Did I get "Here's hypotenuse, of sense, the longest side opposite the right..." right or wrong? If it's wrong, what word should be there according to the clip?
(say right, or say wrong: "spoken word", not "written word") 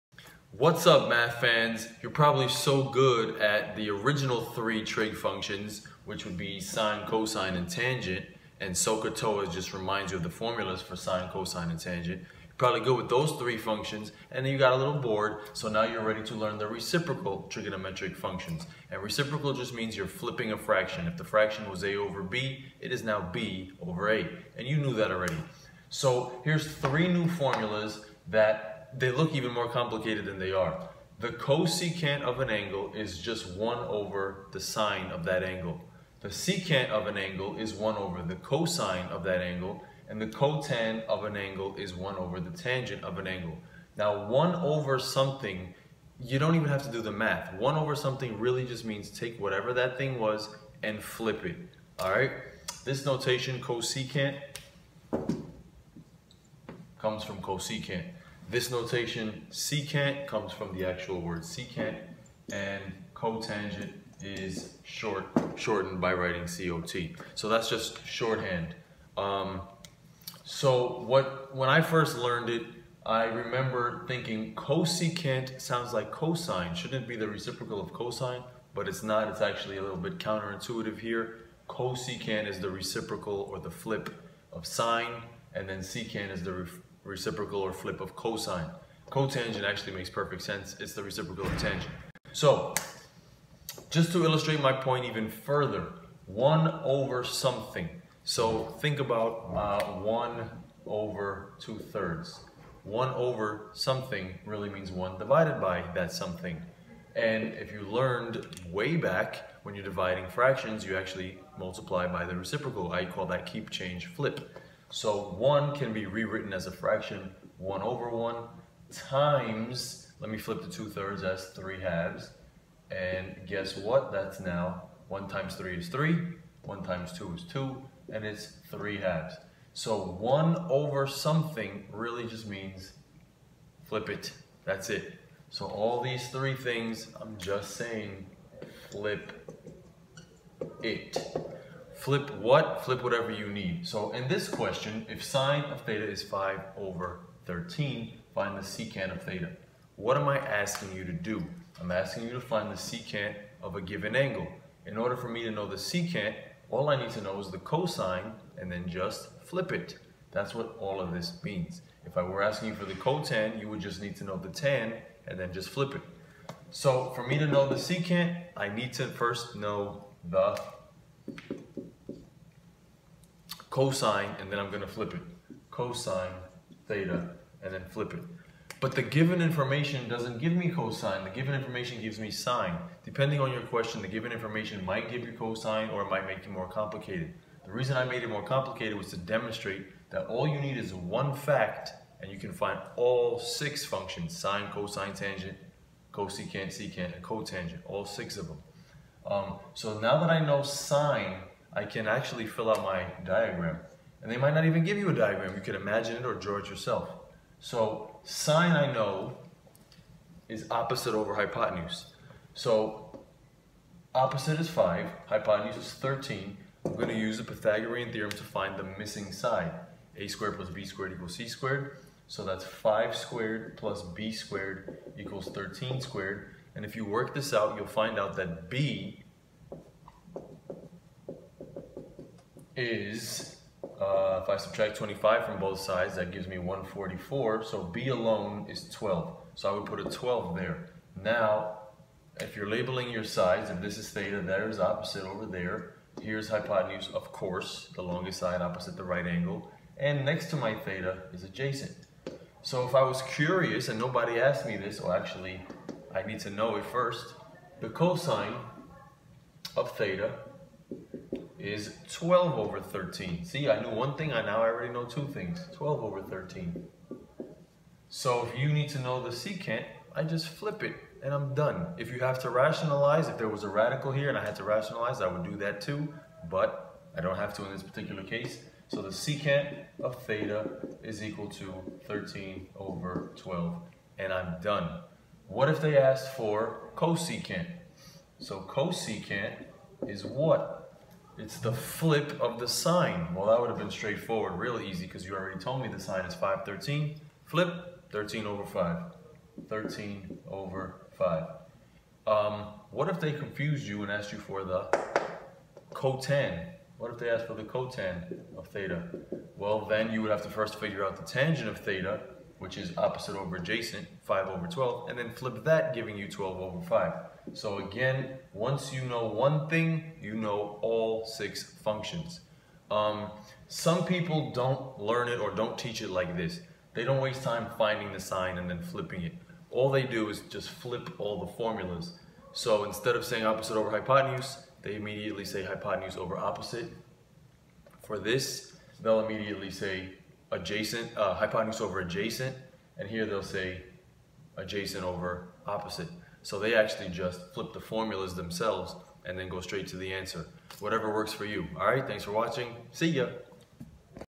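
wrong: "course", not "sense".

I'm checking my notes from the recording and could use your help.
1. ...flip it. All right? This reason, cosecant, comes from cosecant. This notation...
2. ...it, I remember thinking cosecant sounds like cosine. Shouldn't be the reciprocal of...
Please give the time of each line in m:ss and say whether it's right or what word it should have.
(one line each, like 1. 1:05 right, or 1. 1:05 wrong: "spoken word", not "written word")
1. 0:51 wrong: "notation", not "reason"
2. 1:12 right.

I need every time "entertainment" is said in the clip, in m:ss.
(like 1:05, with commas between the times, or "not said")
not said.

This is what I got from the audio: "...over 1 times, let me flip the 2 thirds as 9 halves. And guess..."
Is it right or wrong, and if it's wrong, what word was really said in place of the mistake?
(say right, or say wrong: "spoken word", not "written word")
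wrong: "3", not "9".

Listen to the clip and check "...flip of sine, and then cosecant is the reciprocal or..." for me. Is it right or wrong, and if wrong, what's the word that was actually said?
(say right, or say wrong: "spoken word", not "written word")
wrong: "secant", not "cosecant".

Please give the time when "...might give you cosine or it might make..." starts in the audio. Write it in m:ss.
3:04.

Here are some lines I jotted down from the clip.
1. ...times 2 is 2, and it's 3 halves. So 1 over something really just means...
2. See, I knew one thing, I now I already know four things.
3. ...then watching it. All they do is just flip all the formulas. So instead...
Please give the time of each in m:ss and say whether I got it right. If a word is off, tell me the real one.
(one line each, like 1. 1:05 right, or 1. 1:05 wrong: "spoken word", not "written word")
1. 2:06 right
2. 4:23 wrong: "two", not "four"
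3. 5:28 wrong: "flipping", not "watching".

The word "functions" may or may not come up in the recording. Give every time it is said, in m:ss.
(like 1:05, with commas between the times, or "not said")
0:05, 0:13, 0:18, 3:13, 5:21.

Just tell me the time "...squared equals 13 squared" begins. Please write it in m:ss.
3:44.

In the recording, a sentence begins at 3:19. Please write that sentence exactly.
Um, so now that I know sine I can actually fill out my diagram.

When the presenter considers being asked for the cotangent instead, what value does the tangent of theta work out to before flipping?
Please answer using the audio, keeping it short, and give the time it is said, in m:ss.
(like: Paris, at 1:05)
5/12, at 5:14.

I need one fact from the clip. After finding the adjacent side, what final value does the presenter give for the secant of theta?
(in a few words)
13/12.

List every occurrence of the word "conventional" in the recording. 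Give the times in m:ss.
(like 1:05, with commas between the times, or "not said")
not said.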